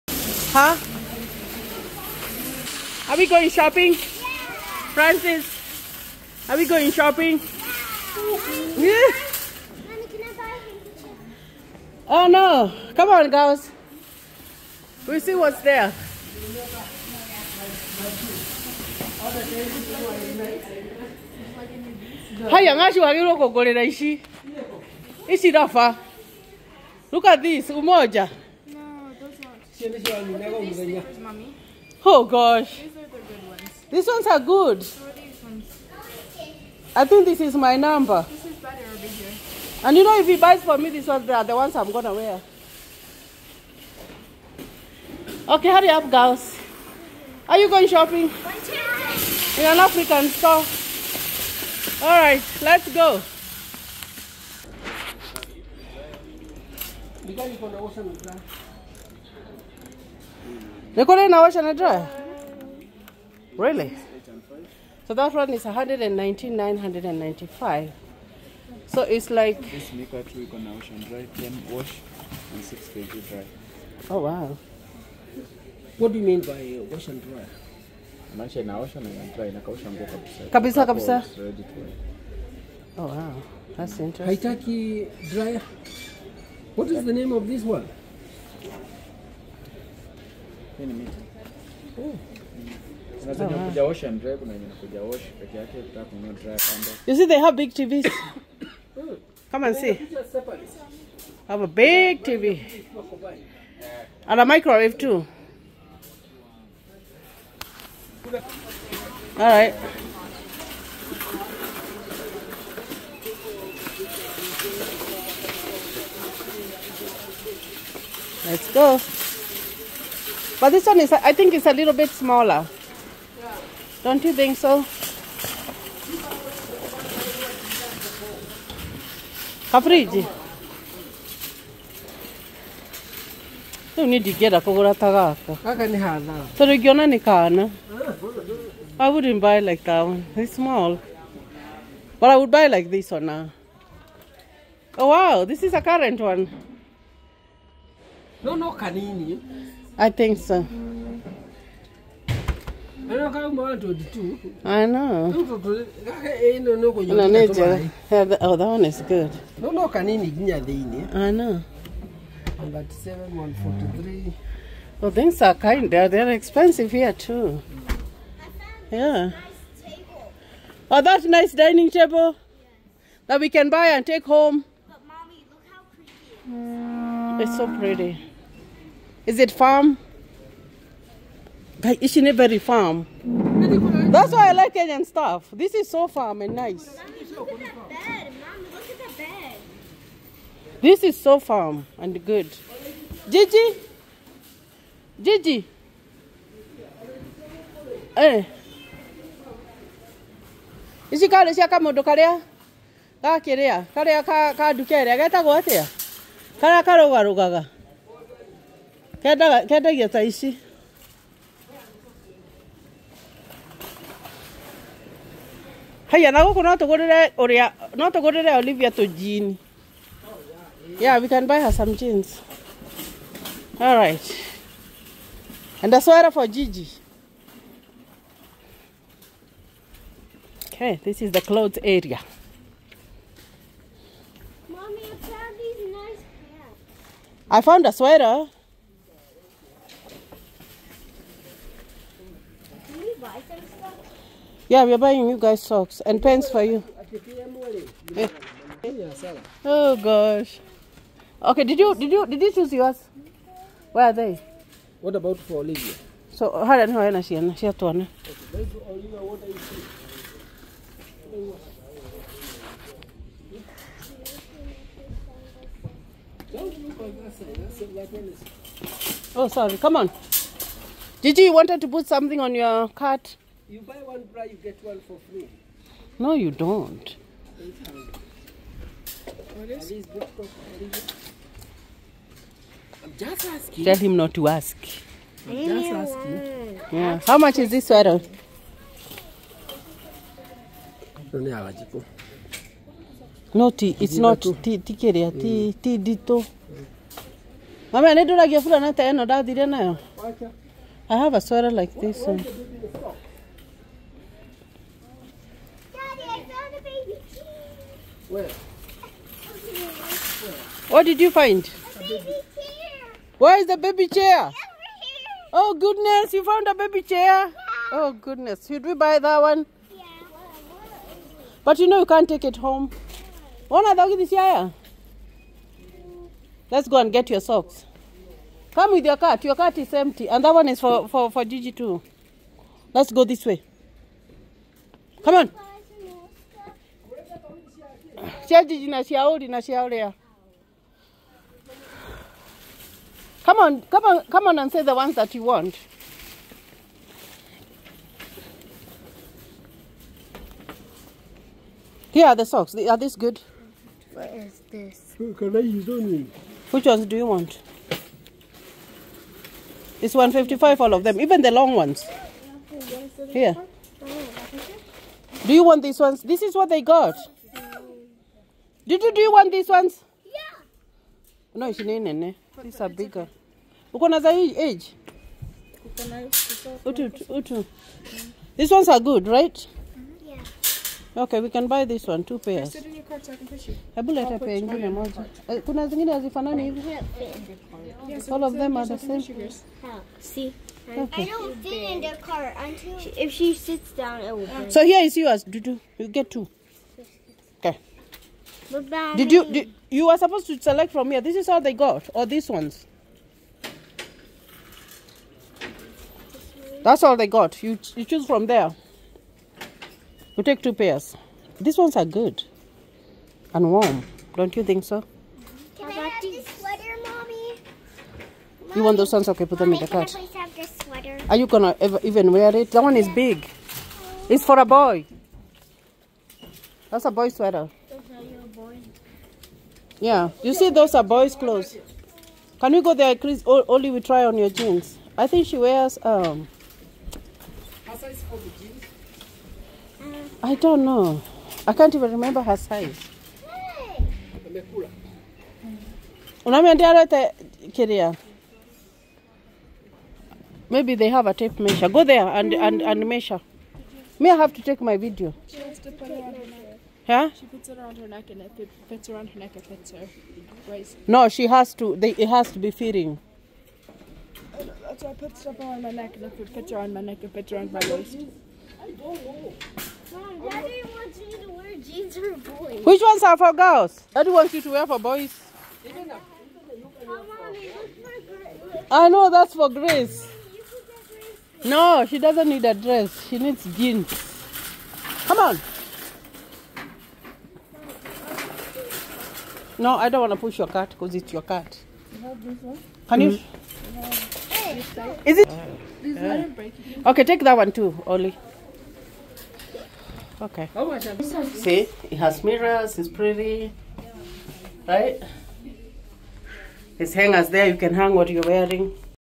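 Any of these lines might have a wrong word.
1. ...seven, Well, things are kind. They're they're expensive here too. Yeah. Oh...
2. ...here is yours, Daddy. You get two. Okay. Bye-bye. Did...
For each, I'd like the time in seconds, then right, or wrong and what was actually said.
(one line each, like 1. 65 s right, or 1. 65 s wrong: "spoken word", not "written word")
1. 162 s right
2. 394 s wrong: "Dudu", not "Daddy".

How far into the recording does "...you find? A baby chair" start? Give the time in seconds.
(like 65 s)
311 s.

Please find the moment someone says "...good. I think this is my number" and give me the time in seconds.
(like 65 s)
34 s.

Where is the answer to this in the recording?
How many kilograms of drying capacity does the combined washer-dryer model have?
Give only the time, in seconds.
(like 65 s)
72 s.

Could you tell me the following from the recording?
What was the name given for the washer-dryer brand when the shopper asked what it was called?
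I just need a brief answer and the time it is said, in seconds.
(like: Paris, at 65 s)
miti, at 90 s.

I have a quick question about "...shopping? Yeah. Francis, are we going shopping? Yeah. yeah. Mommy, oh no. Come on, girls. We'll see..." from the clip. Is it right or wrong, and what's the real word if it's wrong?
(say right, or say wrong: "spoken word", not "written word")
right.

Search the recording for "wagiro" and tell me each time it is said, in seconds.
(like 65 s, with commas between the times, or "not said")
22 s.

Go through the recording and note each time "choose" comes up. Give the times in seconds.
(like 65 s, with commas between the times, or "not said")
252 s, 408 s.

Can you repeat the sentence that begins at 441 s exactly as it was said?
I can't even remember her size.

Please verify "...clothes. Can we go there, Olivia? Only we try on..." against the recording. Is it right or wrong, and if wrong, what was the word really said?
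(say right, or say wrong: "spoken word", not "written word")
wrong: "Chris", not "Olivia".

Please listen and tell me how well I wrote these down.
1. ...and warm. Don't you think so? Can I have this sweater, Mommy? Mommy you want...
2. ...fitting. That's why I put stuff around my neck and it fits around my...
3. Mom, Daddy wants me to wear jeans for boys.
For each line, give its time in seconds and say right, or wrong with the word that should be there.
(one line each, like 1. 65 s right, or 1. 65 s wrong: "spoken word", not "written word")
1. 413 s right
2. 462 s right
3. 470 s right.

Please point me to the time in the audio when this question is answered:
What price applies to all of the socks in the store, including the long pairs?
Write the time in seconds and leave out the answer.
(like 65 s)
360 s.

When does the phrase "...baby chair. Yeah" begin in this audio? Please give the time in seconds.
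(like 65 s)
316 s.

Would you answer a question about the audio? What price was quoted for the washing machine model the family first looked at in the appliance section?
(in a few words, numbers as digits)
119,995.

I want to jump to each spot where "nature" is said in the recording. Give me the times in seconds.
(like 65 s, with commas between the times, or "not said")
157 s.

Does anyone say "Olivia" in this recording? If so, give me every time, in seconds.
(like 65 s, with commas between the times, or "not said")
218 s, 255 s.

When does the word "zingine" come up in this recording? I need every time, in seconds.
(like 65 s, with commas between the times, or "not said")
385 s.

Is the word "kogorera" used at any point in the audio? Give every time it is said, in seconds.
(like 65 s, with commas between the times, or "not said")
23 s.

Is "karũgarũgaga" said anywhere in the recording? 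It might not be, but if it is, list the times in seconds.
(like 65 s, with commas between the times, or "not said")
206 s.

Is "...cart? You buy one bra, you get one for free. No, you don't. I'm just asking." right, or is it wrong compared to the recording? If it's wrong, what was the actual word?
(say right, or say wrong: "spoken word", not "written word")
right.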